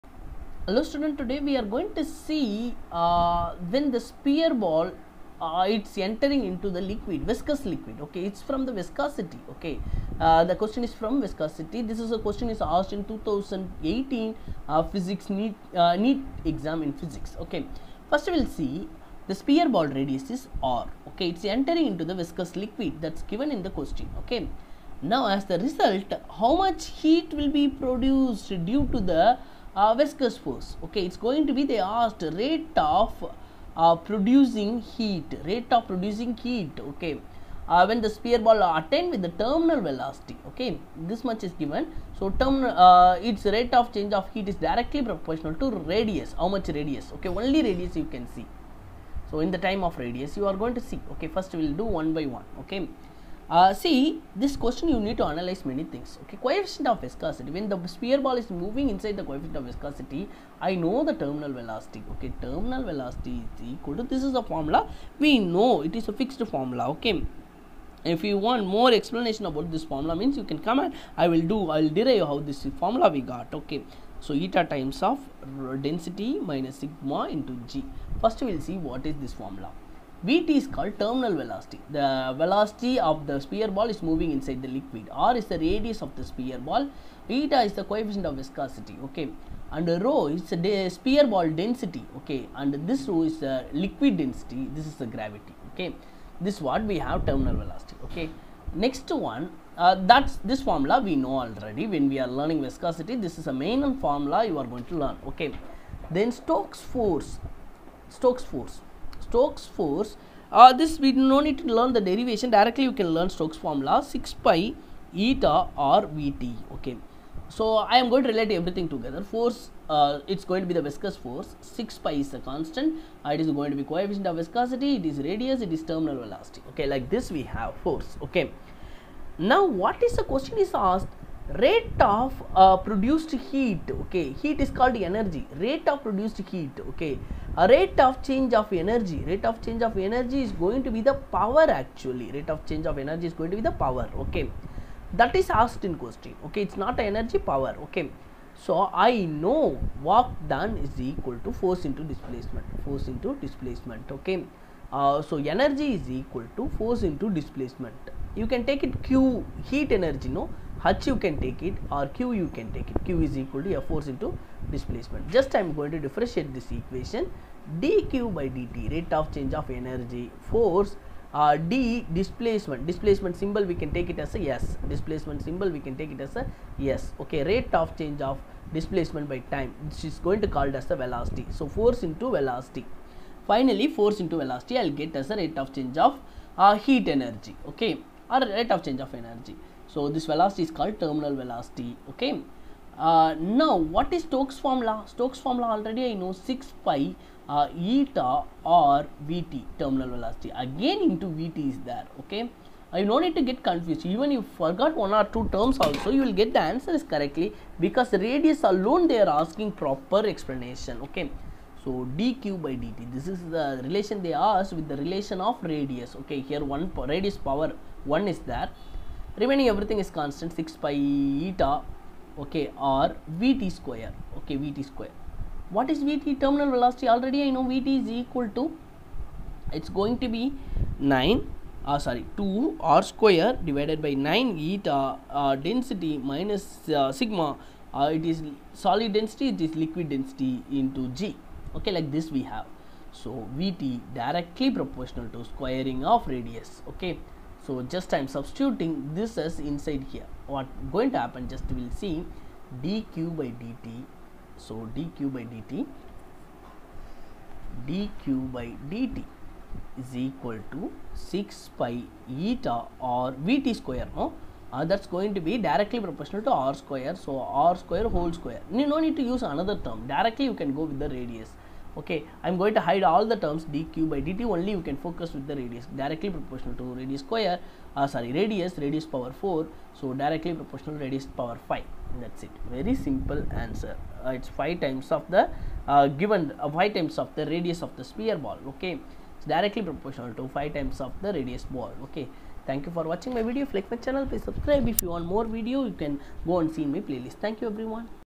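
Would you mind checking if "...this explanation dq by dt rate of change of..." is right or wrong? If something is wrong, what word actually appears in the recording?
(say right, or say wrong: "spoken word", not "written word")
wrong: "equation", not "explanation".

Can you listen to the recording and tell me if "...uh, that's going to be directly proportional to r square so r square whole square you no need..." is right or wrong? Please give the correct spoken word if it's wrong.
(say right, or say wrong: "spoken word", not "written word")
right.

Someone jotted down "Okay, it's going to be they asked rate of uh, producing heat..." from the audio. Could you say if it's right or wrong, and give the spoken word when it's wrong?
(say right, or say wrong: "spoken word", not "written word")
right.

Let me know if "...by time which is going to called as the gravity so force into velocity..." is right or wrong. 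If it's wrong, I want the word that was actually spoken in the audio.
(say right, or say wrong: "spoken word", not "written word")
wrong: "velocity", not "gravity".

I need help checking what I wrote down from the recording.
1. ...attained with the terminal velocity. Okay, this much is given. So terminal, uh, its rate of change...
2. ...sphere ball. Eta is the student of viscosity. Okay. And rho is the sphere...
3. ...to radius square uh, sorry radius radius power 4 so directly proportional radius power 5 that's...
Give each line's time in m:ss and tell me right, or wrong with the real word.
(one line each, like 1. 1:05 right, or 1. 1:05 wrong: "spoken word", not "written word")
1. 0:38 right
2. 1:26 wrong: "coefficient", not "student"
3. 4:36 right.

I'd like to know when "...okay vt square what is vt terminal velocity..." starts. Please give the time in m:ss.
3:44.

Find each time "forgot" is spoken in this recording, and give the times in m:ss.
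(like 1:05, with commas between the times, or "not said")
3:24.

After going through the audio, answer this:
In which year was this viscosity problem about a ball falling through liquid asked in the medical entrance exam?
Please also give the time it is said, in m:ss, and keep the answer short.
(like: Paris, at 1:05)
2018, at 0:13.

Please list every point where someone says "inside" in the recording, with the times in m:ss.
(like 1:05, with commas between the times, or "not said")
0:58, 1:24, 4:09.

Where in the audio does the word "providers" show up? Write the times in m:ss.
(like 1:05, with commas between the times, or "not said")
not said.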